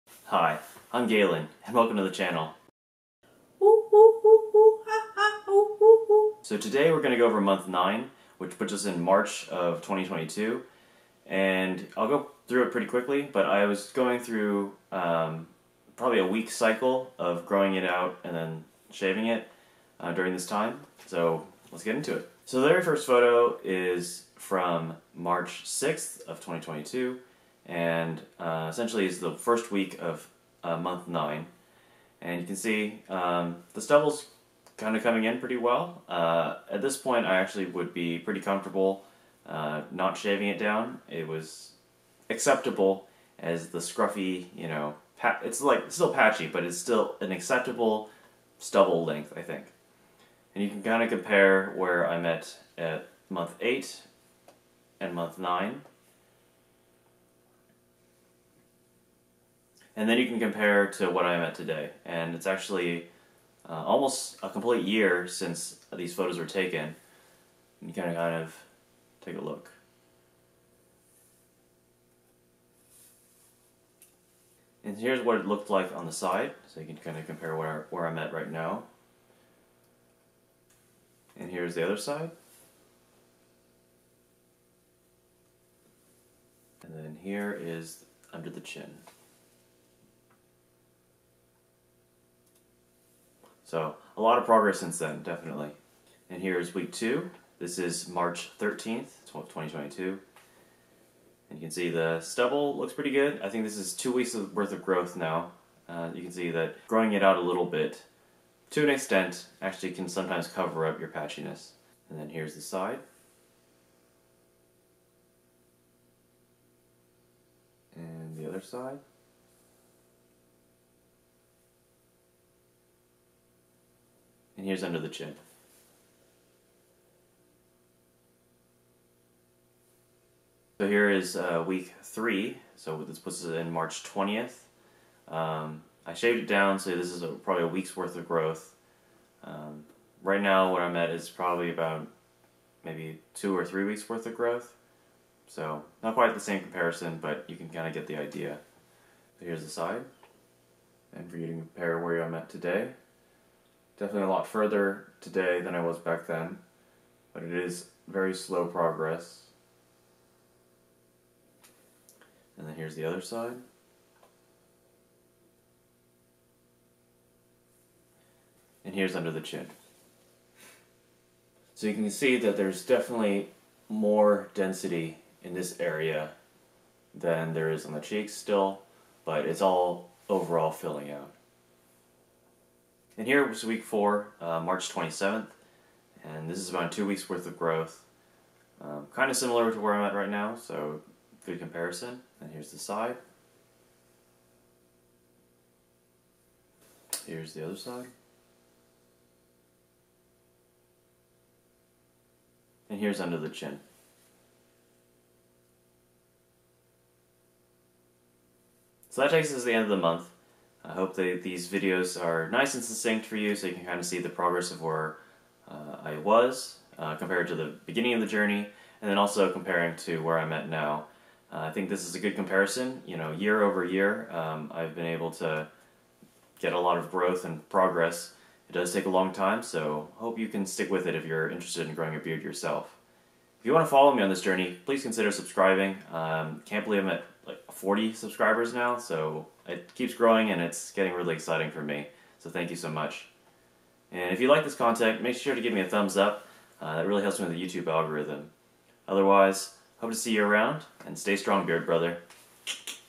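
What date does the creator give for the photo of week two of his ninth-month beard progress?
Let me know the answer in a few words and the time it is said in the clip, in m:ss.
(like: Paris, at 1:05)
March 13th, 2022, at 1:38.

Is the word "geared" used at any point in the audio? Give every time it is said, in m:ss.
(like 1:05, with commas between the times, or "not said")
not said.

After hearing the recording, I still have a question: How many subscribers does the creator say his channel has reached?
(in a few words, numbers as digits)
40.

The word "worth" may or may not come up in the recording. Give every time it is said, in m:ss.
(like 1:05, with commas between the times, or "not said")
1:44, 2:17, 2:24, 3:07.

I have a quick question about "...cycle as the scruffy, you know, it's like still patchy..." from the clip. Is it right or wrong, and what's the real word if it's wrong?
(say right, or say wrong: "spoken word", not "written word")
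wrong: "acceptable", not "cycle".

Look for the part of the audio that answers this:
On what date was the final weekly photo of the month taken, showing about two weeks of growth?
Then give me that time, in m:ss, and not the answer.
3:04.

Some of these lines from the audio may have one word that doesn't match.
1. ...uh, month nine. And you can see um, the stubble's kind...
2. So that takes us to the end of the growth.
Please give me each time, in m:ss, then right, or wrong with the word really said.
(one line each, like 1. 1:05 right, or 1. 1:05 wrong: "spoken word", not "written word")
1. 0:30 right
2. 3:29 wrong: "month", not "growth".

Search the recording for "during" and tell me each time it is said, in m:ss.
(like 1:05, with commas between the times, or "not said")
0:20.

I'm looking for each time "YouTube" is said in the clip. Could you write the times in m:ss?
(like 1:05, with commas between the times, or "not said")
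4:07.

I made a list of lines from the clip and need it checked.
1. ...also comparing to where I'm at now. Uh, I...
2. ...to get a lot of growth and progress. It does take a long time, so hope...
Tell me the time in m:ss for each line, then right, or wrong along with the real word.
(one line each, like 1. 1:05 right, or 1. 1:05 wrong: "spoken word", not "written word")
1. 3:39 right
2. 3:45 right.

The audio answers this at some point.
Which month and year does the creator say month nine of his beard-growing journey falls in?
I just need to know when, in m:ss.
0:09.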